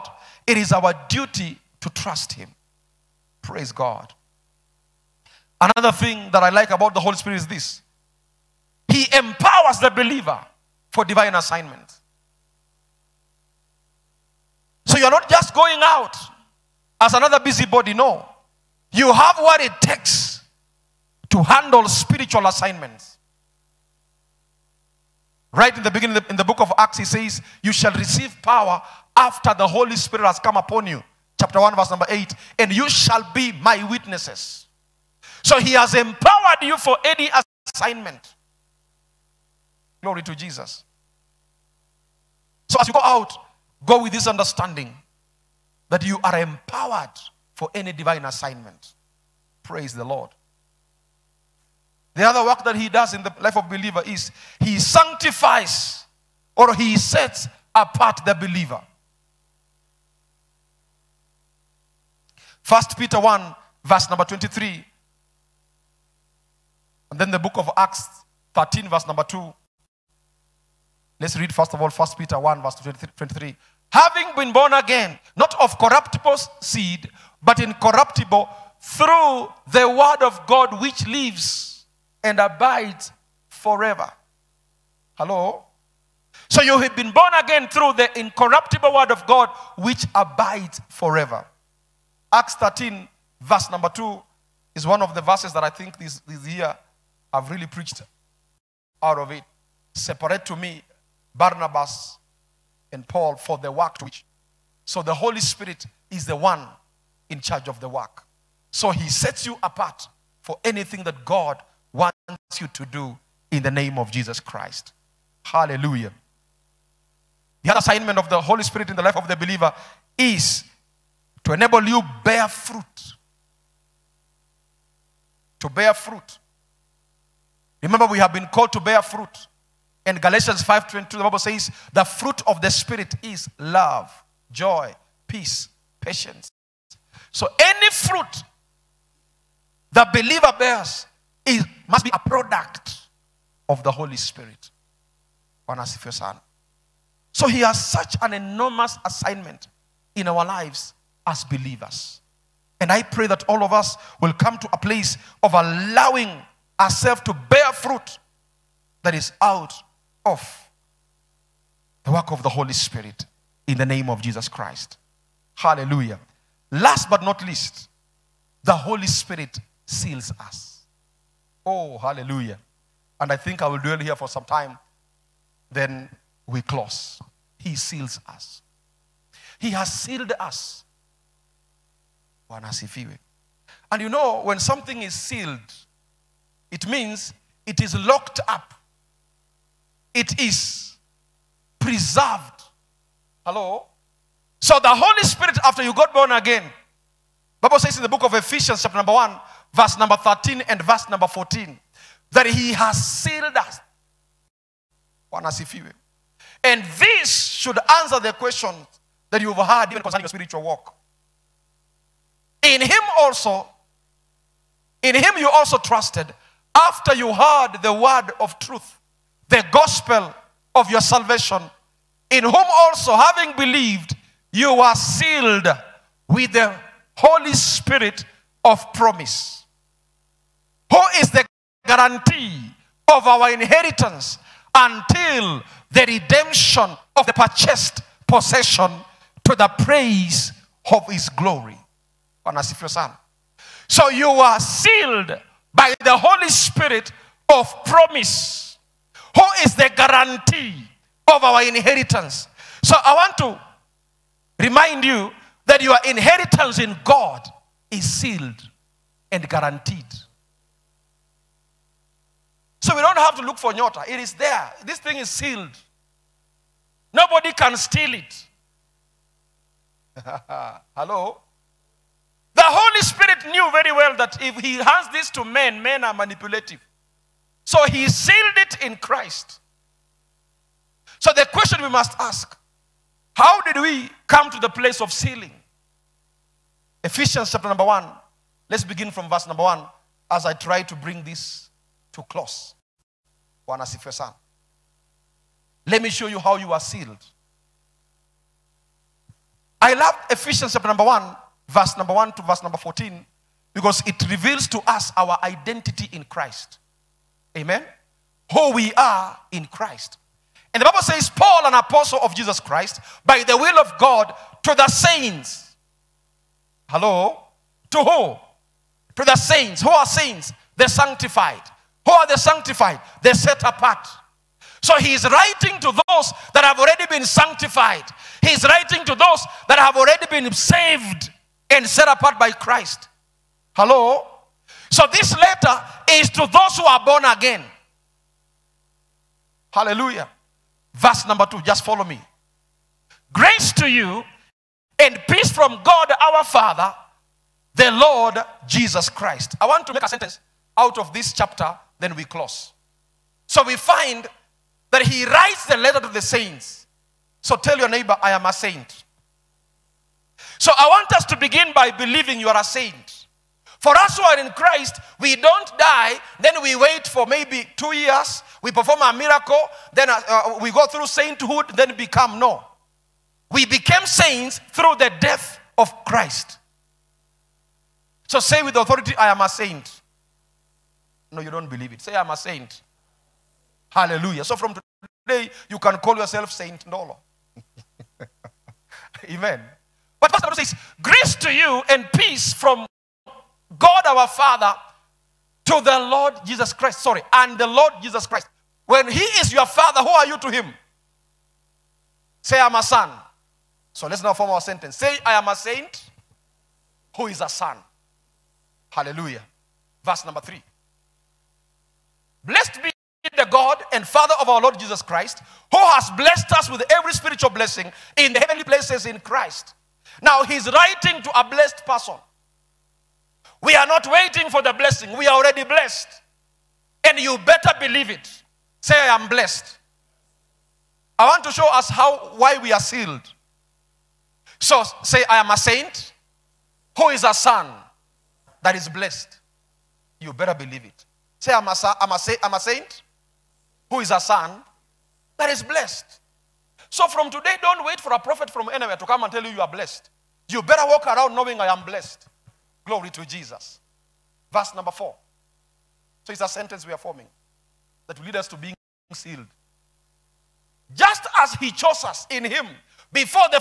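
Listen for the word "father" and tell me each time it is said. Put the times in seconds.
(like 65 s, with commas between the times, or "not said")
346 s, 394 s, 399 s, 414 s.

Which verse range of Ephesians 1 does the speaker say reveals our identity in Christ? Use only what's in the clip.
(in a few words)
1 to 14.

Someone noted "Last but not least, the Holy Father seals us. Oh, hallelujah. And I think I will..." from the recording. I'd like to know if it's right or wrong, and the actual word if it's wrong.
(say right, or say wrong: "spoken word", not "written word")
wrong: "Spirit", not "Father".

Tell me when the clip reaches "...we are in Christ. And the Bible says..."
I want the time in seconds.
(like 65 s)
308 s.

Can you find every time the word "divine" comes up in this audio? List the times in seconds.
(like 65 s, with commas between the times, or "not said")
11 s, 47 s.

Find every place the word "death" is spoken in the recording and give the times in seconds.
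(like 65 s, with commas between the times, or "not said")
375 s.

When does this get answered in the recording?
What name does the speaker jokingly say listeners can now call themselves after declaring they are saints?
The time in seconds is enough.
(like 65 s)
386 s.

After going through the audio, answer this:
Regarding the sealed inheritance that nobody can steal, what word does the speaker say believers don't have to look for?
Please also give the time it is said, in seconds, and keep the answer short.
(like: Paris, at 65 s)
Nyota, at 263 s.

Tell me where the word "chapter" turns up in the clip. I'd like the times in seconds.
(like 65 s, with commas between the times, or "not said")
31 s, 198 s, 287 s, 300 s, 351 s.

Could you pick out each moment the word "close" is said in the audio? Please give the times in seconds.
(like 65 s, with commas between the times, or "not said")
176 s, 292 s, 352 s.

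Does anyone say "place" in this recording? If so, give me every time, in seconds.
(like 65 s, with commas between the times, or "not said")
154 s, 284 s, 418 s.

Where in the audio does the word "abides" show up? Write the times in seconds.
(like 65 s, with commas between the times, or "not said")
82 s, 90 s.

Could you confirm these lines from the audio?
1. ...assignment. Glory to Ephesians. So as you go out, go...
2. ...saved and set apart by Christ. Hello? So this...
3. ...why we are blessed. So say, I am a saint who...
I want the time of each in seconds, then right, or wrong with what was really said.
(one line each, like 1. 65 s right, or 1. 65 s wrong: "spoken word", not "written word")
1. 37 s wrong: "Jesus", not "Ephesians"
2. 330 s right
3. 432 s wrong: "sealed", not "blessed".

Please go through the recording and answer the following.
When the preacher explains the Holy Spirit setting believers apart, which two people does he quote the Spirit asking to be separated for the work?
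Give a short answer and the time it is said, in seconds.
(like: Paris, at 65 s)
Barnabas and Paul, at 101 s.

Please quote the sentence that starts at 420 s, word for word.
Now he's writing to a blessed person.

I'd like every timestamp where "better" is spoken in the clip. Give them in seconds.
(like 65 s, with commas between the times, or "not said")
427 s, 440 s, 450 s.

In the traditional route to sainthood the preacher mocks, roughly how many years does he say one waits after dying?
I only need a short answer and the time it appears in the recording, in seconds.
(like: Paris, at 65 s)
2, at 367 s.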